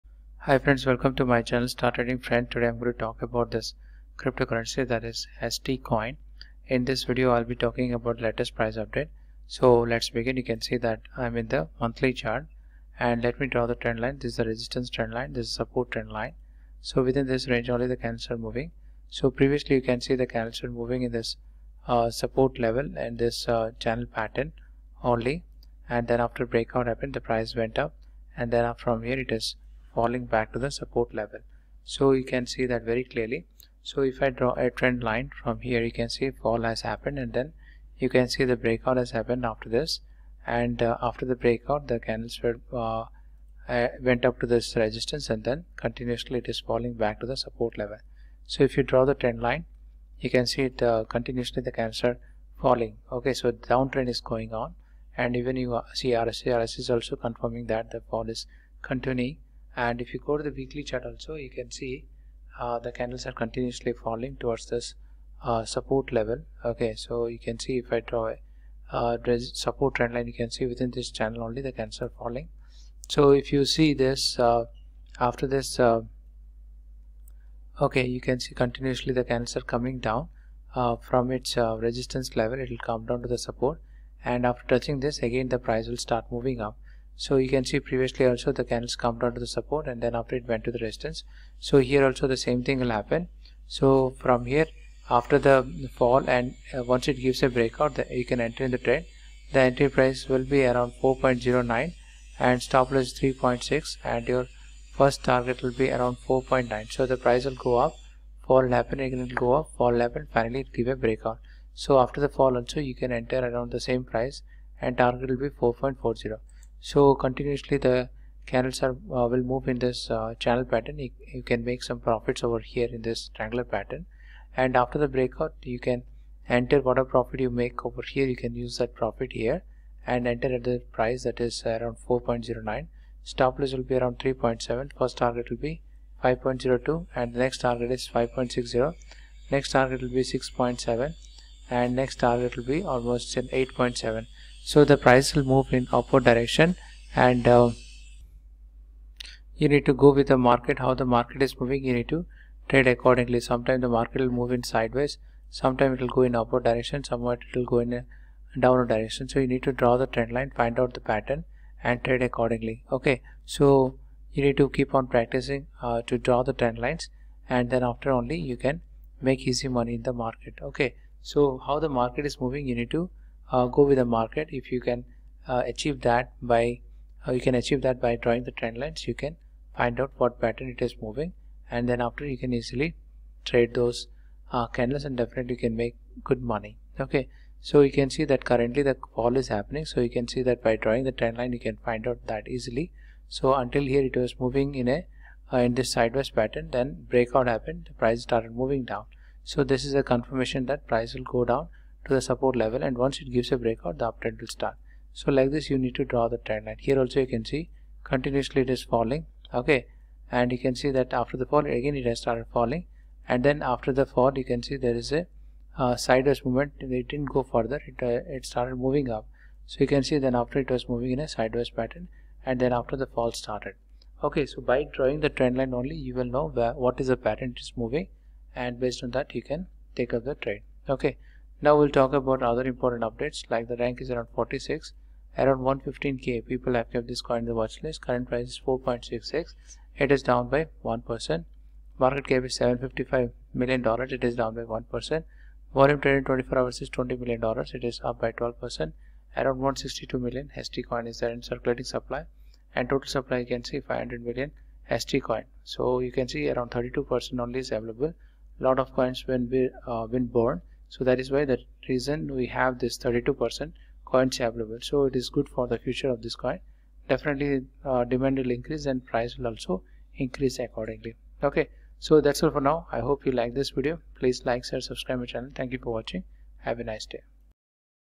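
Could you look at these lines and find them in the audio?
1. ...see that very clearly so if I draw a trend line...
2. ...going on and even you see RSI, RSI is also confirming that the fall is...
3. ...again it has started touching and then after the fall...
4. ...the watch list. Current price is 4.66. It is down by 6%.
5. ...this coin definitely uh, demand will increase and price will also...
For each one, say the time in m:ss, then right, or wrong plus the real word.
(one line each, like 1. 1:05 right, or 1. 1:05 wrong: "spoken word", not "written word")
1. 0:32 right
2. 0:54 right
3. 3:31 wrong: "falling", not "touching"
4. 3:57 wrong: "1", not "6"
5. 4:26 right.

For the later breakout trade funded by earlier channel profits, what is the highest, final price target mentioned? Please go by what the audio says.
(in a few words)
8.7.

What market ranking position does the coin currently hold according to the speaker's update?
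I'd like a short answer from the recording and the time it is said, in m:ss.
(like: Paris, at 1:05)
46, at 3:54.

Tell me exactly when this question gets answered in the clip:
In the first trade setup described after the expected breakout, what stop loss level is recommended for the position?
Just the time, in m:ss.
1:42.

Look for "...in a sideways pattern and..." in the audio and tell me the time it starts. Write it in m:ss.
3:41.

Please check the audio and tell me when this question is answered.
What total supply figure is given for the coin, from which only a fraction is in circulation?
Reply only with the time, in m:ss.
4:13.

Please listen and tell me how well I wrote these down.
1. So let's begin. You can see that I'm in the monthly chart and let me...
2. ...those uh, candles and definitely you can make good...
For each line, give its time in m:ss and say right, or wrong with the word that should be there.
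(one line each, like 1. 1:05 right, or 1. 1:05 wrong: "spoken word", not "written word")
1. 0:09 right
2. 3:03 right.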